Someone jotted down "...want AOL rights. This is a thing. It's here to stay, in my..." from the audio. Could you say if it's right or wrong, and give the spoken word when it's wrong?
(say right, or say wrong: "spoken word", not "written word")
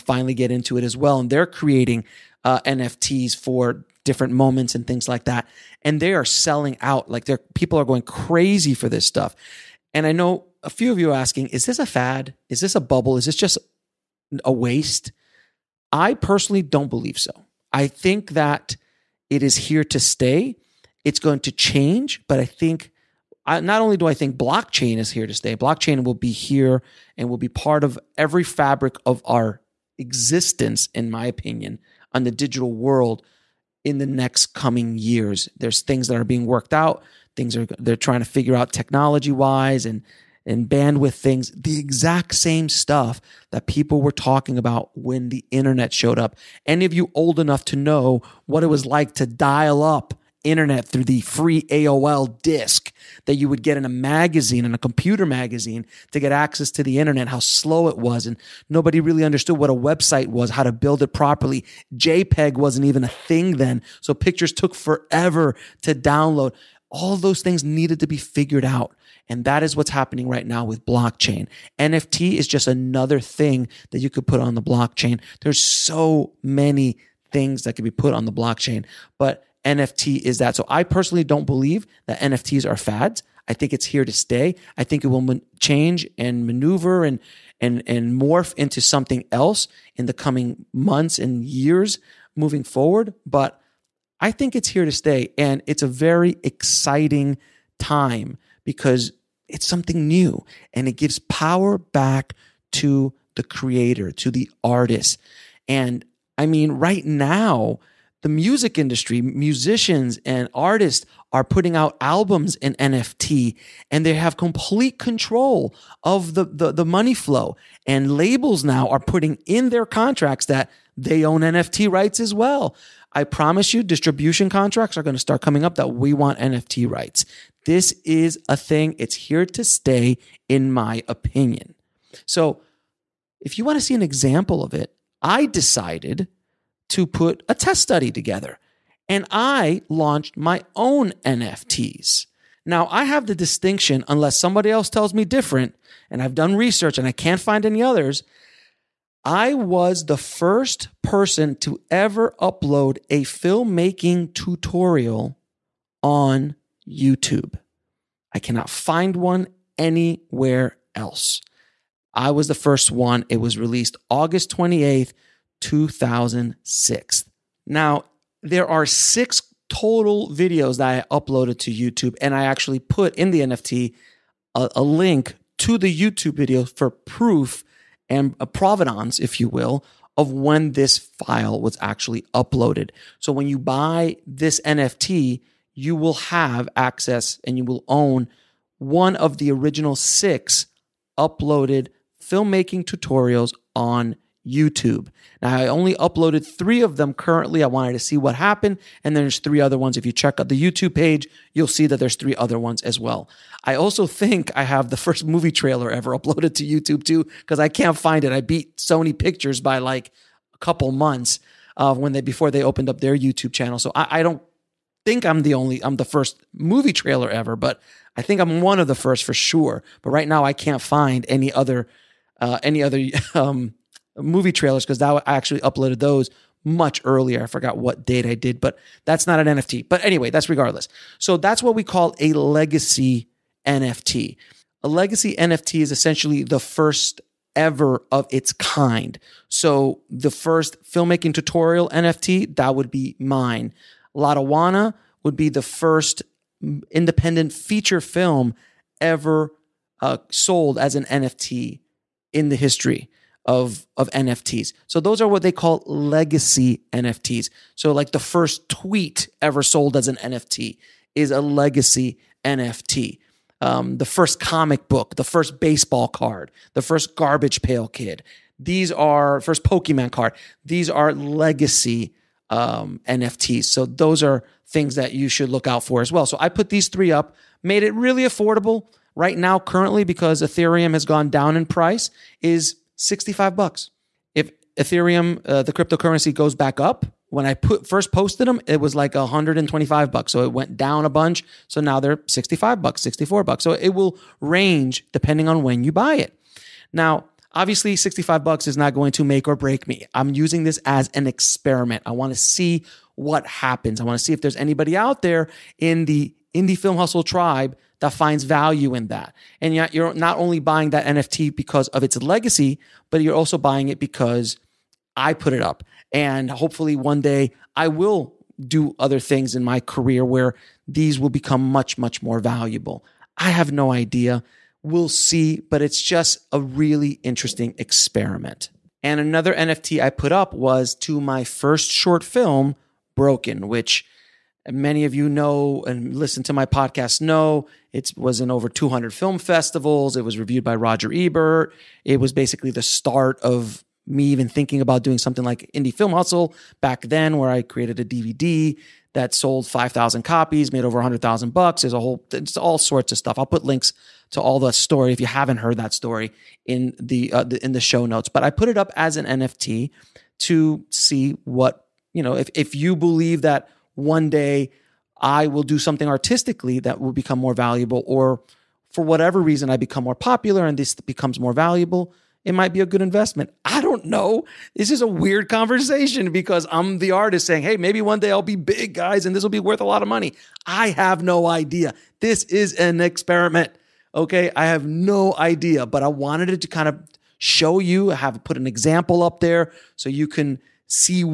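wrong: "NFT", not "AOL".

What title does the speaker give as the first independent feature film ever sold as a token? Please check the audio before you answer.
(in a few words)
Latawana.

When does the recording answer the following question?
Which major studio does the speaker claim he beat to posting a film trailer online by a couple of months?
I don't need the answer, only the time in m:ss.
3:28.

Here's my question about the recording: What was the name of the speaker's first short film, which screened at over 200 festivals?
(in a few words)
Broken.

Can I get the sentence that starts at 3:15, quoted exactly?
Now, I only uploaded three of them currently.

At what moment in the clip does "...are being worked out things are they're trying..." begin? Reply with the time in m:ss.
0:36.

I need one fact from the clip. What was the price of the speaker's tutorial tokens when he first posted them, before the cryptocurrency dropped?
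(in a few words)
$125.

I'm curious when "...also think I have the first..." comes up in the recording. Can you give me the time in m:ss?
3:23.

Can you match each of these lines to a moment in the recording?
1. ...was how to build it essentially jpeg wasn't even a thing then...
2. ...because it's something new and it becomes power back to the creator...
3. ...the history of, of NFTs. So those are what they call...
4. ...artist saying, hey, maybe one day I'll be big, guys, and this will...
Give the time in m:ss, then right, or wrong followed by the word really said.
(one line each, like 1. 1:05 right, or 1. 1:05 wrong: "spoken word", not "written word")
1. 1:00 wrong: "properly", not "essentially"
2. 1:38 wrong: "gives", not "becomes"
3. 4:12 right
4. 6:17 right.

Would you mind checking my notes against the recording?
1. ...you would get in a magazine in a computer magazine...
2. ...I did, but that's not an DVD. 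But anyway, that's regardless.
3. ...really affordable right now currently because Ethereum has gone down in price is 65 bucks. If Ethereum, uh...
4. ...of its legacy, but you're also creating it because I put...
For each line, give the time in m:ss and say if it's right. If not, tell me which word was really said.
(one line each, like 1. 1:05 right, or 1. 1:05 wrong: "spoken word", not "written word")
1. 0:53 right
2. 3:48 wrong: "NFT", not "DVD"
3. 4:37 right
4. 5:11 wrong: "buying", not "creating".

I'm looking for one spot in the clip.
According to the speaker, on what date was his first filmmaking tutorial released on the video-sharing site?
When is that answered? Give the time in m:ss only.
2:44.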